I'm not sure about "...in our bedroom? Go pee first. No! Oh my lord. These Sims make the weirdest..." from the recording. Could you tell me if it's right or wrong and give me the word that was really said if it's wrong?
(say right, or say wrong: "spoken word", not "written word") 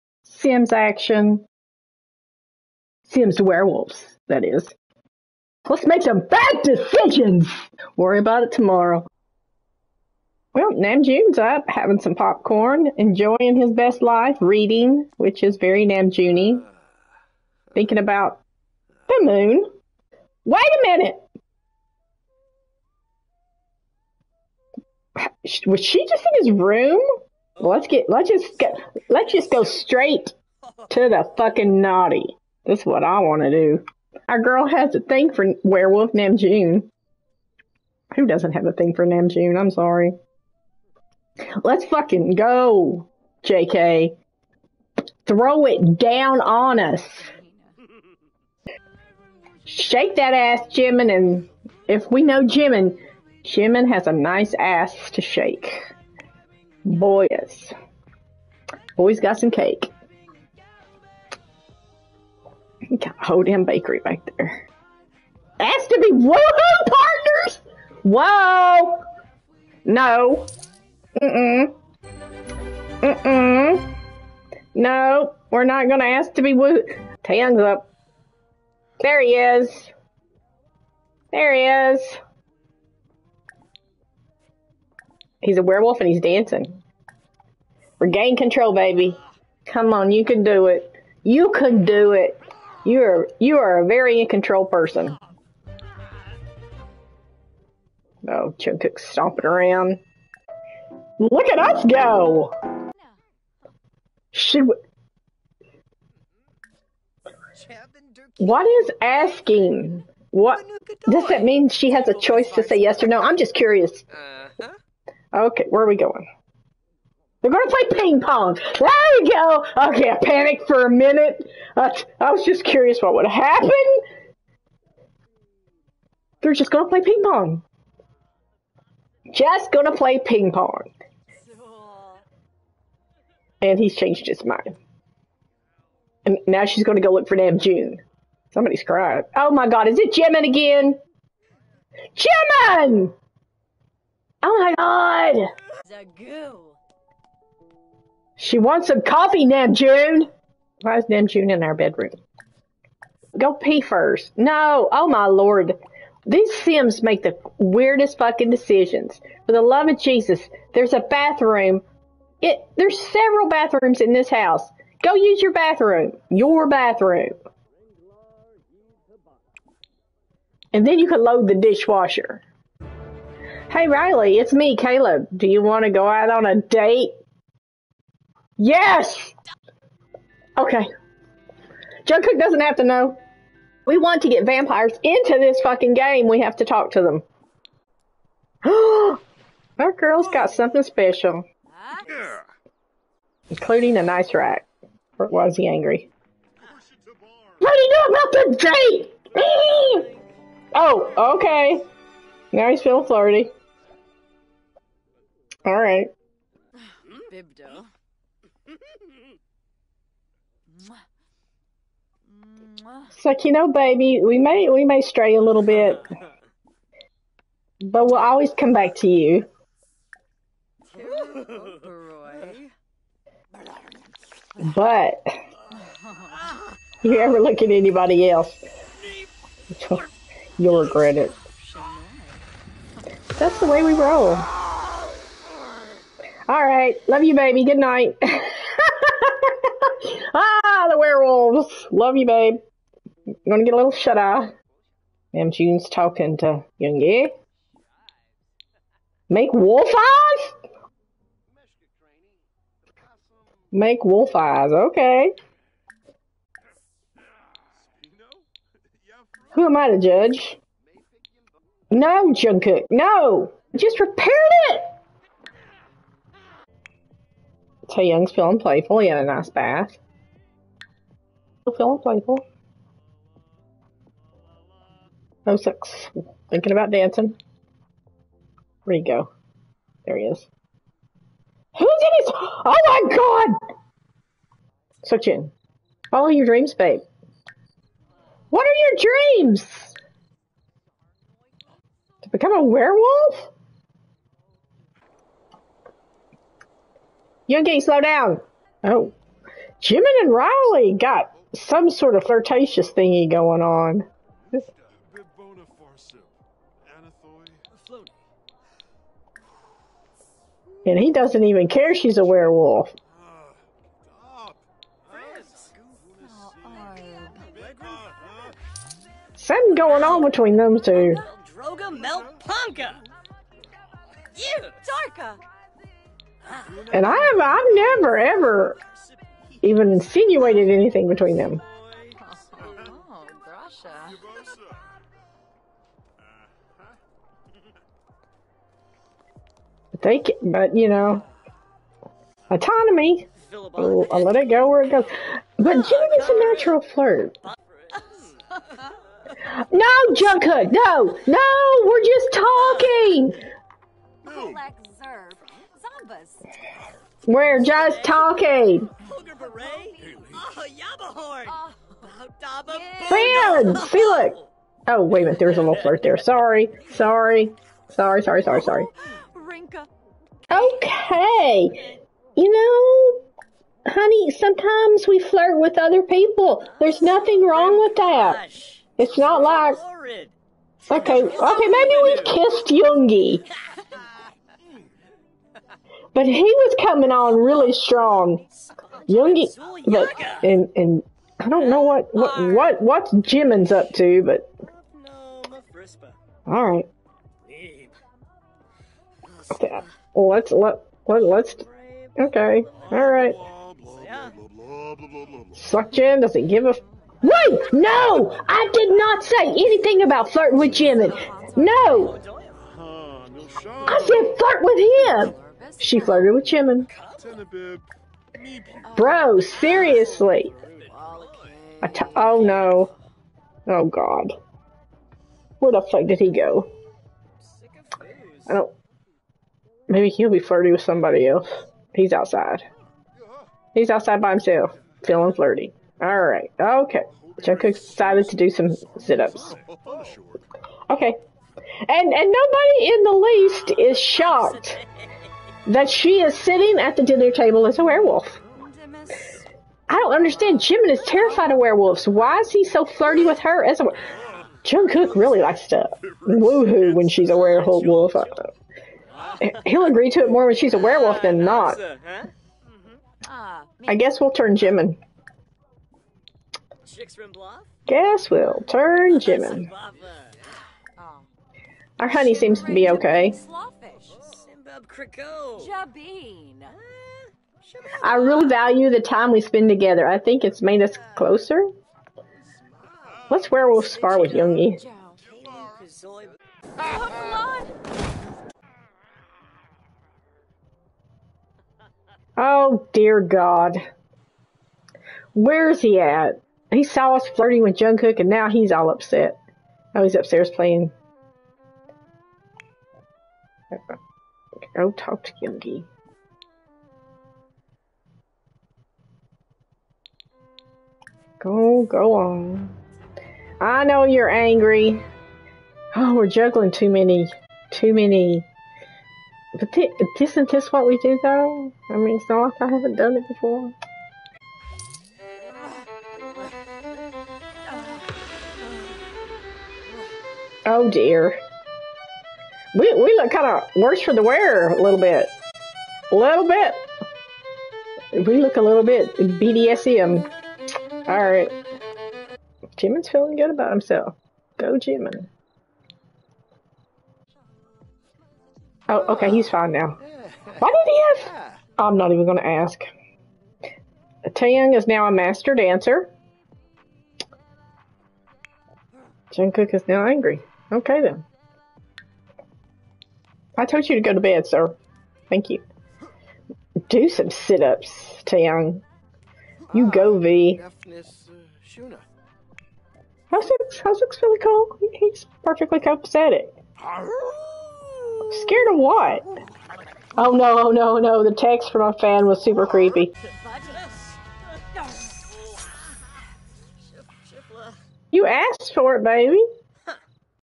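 right.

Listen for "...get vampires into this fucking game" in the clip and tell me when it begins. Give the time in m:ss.
3:04.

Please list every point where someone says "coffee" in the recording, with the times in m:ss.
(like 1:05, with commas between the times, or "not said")
2:29.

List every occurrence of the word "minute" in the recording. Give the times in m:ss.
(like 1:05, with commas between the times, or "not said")
0:20, 2:00, 6:05.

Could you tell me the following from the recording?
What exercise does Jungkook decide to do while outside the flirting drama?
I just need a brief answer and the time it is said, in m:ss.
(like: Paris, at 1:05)
Sit-ups, at 7:18.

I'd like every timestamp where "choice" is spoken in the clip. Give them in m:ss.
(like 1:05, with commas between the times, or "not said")
1:52.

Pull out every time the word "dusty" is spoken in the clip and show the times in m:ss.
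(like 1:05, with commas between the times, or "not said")
not said.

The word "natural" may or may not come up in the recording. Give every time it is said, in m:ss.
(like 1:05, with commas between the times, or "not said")
5:46.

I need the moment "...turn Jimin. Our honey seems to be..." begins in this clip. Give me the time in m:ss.
7:48.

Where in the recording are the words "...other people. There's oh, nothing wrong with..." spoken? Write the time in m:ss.
6:15.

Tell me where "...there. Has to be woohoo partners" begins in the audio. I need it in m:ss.
1:04.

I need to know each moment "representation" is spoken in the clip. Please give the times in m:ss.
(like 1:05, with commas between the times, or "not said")
not said.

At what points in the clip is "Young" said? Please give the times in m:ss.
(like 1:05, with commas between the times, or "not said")
4:06, 4:28.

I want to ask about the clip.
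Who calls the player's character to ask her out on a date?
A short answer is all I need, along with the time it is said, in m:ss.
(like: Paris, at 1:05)
Caleb, at 2:54.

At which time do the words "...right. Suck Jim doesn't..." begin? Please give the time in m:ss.
6:43.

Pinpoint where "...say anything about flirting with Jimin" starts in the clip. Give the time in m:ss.
6:49.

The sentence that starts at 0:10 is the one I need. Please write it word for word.
Well, June's up, having some popcorn, enjoying his best life, reading, which is very Namjoonie, thinking about the moon.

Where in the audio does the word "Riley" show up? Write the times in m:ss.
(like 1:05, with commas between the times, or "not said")
2:53, 5:00.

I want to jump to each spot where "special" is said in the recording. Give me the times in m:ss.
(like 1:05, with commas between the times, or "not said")
3:10.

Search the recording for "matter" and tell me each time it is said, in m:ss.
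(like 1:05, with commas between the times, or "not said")
not said.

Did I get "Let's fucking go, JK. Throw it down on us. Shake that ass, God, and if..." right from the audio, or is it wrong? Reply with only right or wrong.
wrong.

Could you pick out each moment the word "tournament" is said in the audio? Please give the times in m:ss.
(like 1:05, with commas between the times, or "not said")
not said.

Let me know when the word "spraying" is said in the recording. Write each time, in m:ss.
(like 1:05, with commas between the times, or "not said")
not said.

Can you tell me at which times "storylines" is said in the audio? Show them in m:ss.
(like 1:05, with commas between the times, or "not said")
not said.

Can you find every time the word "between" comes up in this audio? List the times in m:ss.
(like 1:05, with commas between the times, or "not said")
5:20, 5:31.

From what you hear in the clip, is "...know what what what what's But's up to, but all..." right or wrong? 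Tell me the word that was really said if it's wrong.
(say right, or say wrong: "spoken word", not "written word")
wrong: "Jimin", not "But".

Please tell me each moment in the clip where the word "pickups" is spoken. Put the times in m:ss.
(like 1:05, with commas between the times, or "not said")
not said.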